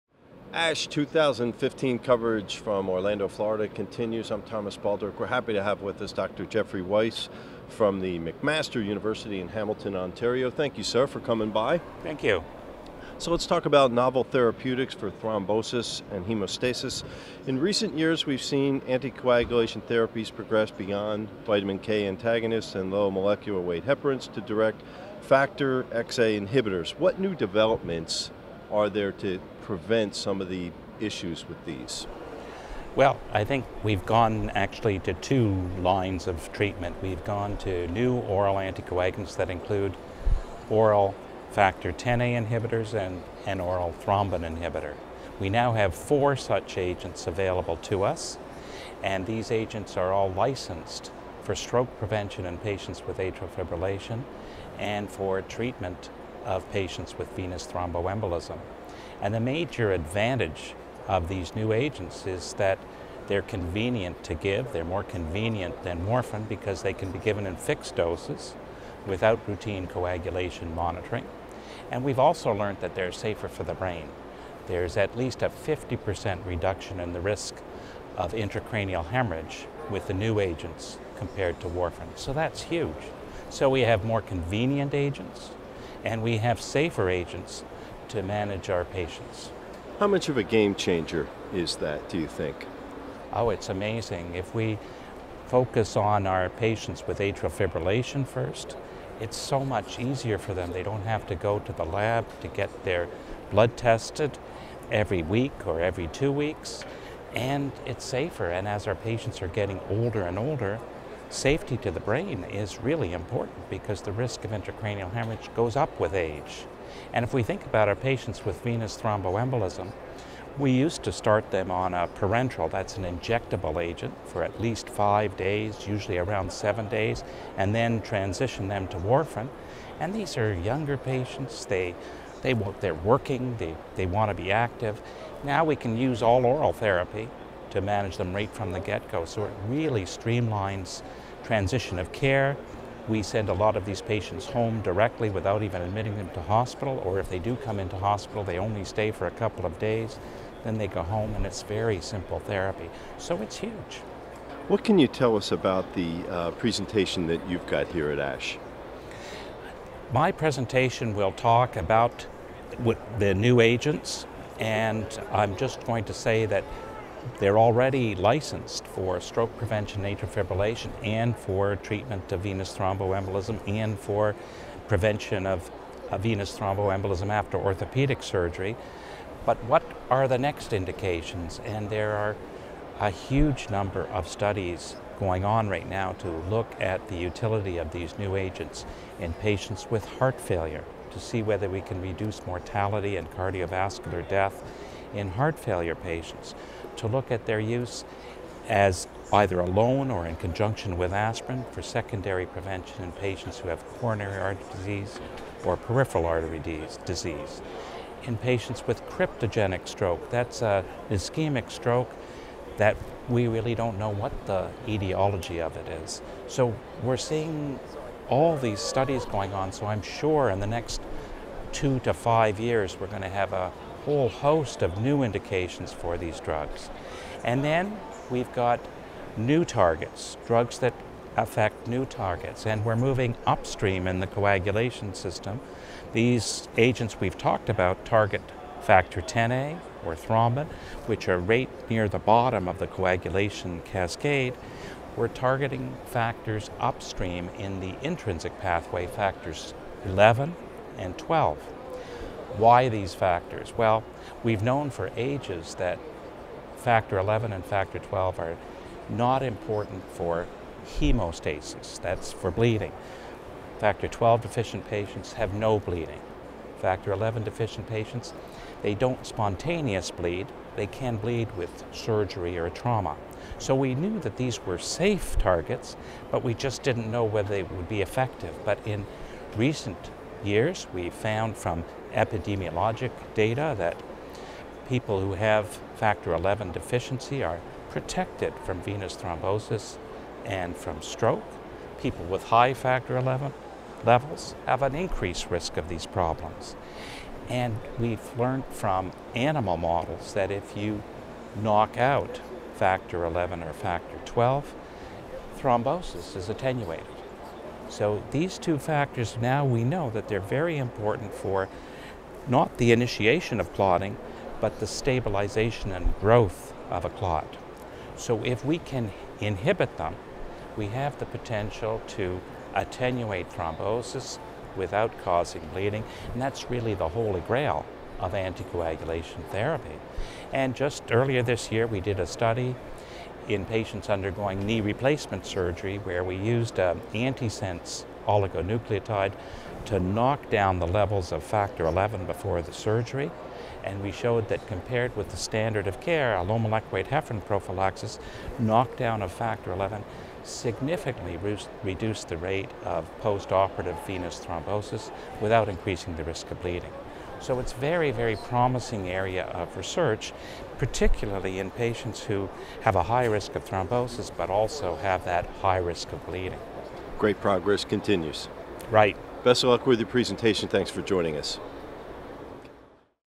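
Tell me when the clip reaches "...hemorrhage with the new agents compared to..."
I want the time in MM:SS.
01:19.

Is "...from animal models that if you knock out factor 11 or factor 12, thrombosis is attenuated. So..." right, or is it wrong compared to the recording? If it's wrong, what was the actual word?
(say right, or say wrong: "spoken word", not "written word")
right.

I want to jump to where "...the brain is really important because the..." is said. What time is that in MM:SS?
01:51.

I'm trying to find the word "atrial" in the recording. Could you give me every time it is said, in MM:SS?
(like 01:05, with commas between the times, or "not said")
00:53, 01:37, 02:50.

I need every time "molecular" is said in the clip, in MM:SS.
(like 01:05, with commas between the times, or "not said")
00:23, 05:46.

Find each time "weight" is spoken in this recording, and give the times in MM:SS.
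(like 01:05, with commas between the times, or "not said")
00:23, 05:46.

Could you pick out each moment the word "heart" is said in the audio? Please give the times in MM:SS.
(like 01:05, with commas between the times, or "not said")
03:10, 03:15.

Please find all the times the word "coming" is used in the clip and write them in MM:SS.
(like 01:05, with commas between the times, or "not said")
00:11.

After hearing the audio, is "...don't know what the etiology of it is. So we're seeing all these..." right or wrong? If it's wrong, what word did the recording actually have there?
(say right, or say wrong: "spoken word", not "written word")
right.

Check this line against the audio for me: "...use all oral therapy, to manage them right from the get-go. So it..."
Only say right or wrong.
right.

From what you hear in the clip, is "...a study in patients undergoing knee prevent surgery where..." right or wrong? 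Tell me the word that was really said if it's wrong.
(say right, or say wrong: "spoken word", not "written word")
wrong: "replacement", not "prevent".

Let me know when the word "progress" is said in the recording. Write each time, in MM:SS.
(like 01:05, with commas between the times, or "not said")
00:20, 06:07.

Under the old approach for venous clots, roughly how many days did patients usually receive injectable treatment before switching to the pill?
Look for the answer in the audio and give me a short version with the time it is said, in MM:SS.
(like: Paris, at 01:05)
seven, at 02:06.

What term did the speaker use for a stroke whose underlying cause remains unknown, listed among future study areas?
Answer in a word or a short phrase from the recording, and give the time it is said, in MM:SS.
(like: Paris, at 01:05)
cryptogenic stroke, at 03:29.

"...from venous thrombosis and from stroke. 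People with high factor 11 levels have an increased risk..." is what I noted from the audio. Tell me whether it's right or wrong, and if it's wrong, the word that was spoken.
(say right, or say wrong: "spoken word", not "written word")
right.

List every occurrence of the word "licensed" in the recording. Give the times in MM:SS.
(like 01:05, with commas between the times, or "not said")
00:50, 02:48.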